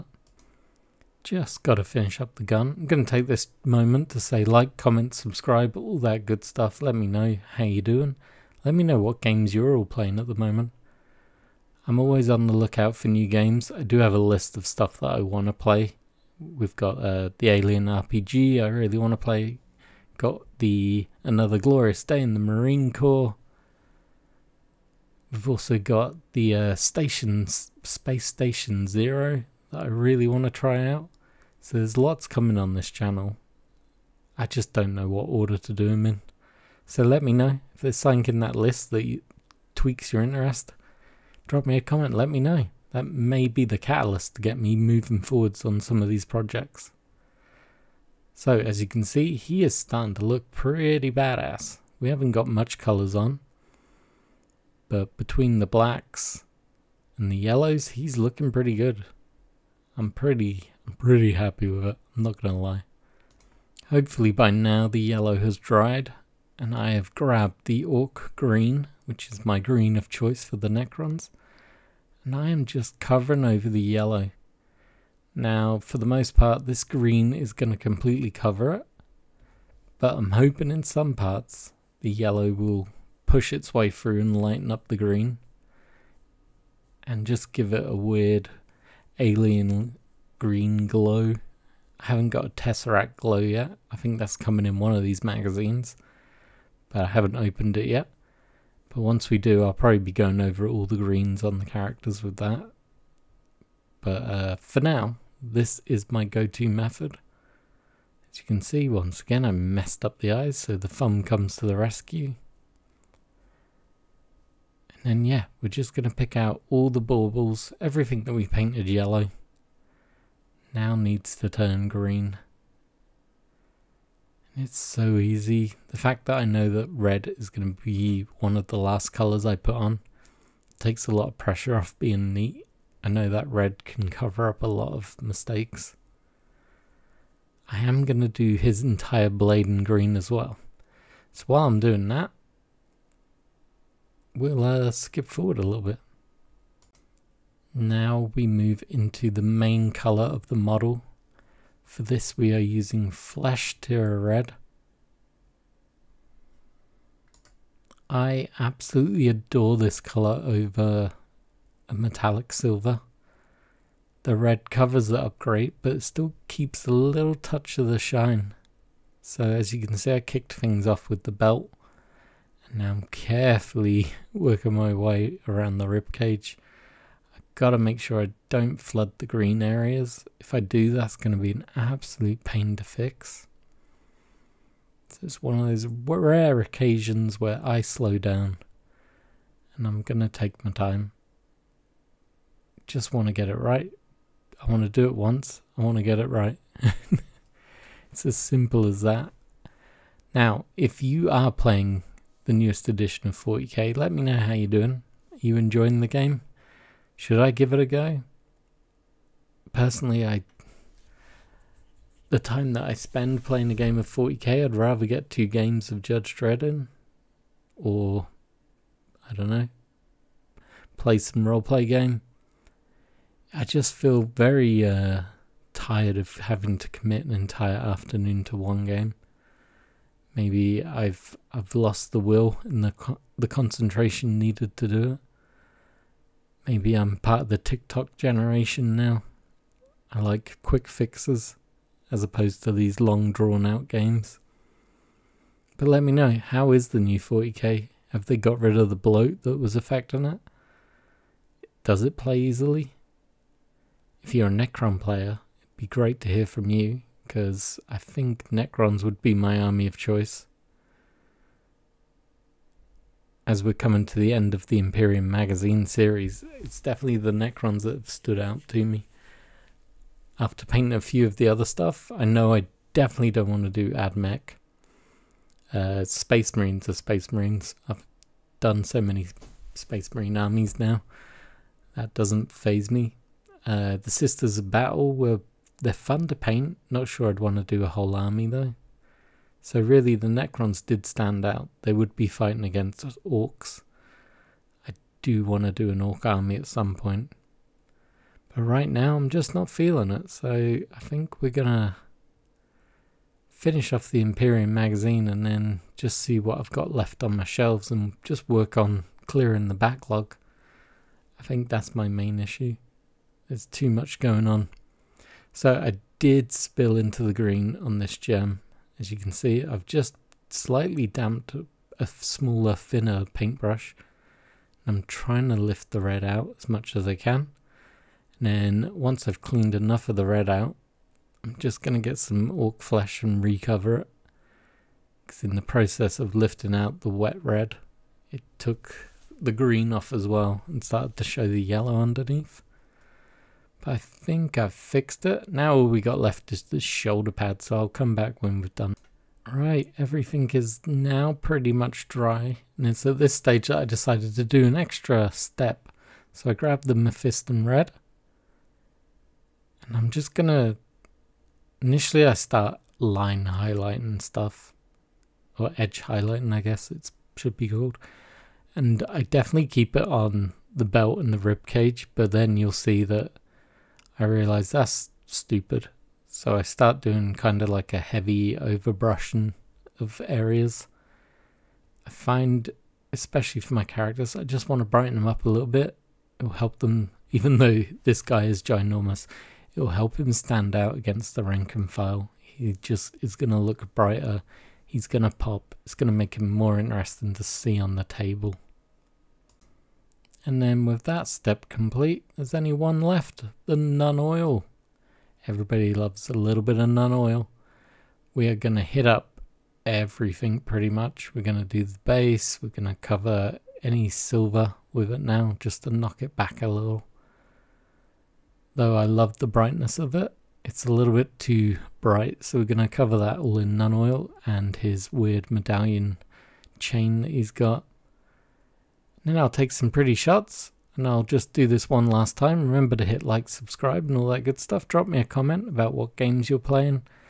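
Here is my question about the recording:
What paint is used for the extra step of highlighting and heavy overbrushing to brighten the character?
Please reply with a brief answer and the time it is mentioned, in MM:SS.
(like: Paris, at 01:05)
Mephiston Red, at 05:56.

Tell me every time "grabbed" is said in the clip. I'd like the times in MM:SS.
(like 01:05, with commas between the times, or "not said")
01:07, 05:56.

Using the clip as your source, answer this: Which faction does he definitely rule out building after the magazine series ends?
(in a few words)
AdMech.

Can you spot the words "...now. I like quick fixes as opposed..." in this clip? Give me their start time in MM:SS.
03:58.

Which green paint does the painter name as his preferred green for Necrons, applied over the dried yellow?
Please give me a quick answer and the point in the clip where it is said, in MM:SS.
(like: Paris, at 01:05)
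Orc Green, at 01:07.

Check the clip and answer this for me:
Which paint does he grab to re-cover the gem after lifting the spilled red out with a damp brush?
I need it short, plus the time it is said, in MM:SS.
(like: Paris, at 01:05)
Ork Flesh, at 05:32.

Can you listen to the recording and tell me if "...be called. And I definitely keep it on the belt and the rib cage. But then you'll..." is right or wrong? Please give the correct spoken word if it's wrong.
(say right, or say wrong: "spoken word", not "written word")
right.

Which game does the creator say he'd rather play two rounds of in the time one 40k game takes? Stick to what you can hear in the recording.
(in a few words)
Judge Dredd.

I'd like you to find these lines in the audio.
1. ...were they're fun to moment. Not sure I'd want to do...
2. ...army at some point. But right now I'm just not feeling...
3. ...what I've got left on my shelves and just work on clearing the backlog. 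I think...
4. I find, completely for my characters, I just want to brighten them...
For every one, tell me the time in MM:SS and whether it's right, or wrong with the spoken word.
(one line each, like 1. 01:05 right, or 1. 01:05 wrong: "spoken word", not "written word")
1. 04:45 wrong: "paint", not "moment"
2. 04:56 right
3. 05:06 right
4. 06:22 wrong: "especially", not "completely".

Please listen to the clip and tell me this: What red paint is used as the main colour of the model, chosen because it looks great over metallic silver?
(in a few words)
Flesh Tearers Red.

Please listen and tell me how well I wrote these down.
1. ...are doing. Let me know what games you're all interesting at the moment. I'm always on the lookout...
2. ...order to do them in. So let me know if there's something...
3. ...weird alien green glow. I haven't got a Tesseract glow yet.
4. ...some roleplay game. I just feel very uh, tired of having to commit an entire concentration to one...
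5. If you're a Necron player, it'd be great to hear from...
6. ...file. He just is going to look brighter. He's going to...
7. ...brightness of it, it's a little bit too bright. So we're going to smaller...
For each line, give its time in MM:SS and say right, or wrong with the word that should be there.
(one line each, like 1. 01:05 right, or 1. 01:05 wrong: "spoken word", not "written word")
1. 00:07 wrong: "playing", not "interesting"
2. 00:35 right
3. 01:27 right
4. 03:41 wrong: "afternoon", not "concentration"
5. 04:14 right
6. 06:31 right
7. 06:59 wrong: "cover", not "smaller".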